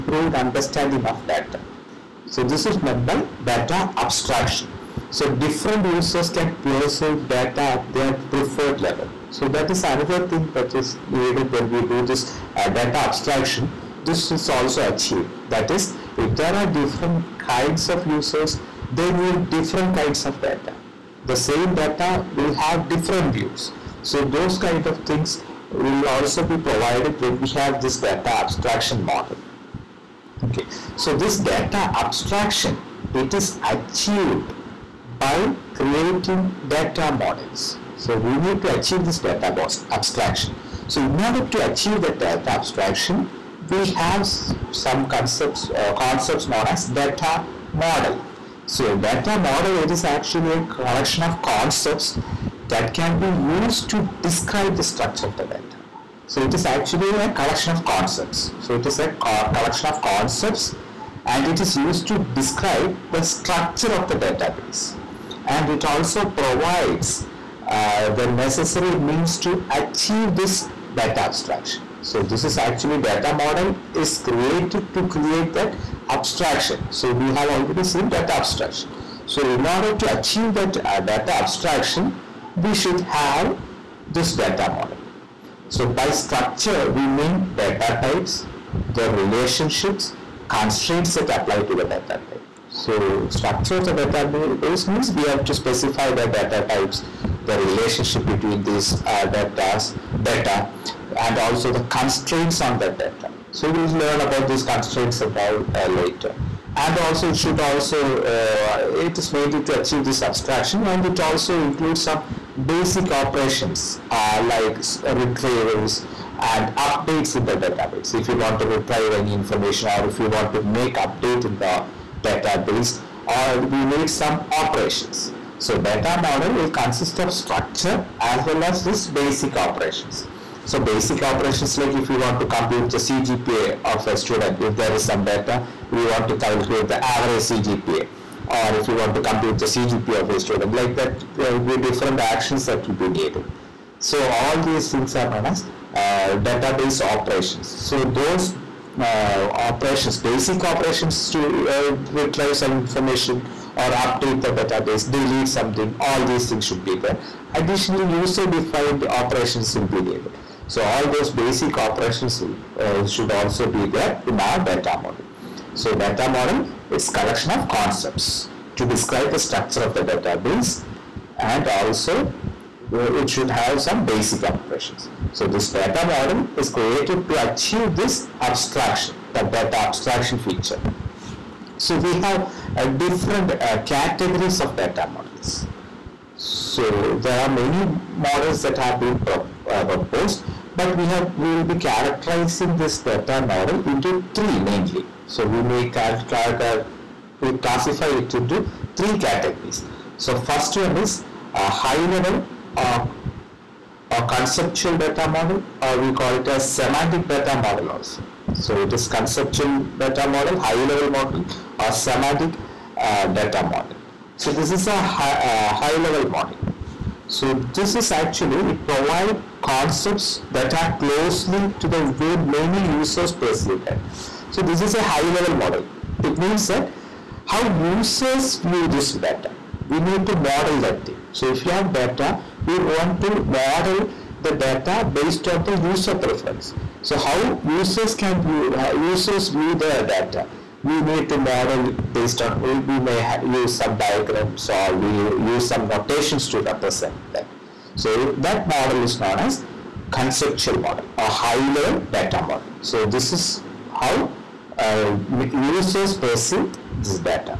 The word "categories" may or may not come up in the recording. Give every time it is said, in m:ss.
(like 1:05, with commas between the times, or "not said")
3:03, 3:19.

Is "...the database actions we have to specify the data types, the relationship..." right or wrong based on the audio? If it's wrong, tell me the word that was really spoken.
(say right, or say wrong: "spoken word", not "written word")
wrong: "means", not "actions".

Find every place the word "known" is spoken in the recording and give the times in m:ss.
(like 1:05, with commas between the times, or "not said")
0:46, 2:25, 4:09.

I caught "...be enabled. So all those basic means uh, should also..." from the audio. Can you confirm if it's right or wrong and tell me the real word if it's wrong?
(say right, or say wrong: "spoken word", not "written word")
wrong: "operations", not "means".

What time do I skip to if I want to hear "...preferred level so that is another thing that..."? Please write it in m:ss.
0:08.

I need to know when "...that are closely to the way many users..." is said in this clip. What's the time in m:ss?
3:40.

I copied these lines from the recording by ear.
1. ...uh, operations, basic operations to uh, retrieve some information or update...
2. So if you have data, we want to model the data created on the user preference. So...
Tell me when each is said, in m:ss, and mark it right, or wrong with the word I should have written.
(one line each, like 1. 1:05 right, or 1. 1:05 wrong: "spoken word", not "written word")
1. 2:29 right
2. 3:51 wrong: "based", not "created".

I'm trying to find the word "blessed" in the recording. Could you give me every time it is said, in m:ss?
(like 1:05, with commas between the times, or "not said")
not said.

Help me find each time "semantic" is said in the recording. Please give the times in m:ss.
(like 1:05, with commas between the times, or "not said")
3:26, 3:31.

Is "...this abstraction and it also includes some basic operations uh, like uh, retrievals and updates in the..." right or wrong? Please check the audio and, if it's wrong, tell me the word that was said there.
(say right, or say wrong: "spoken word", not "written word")
right.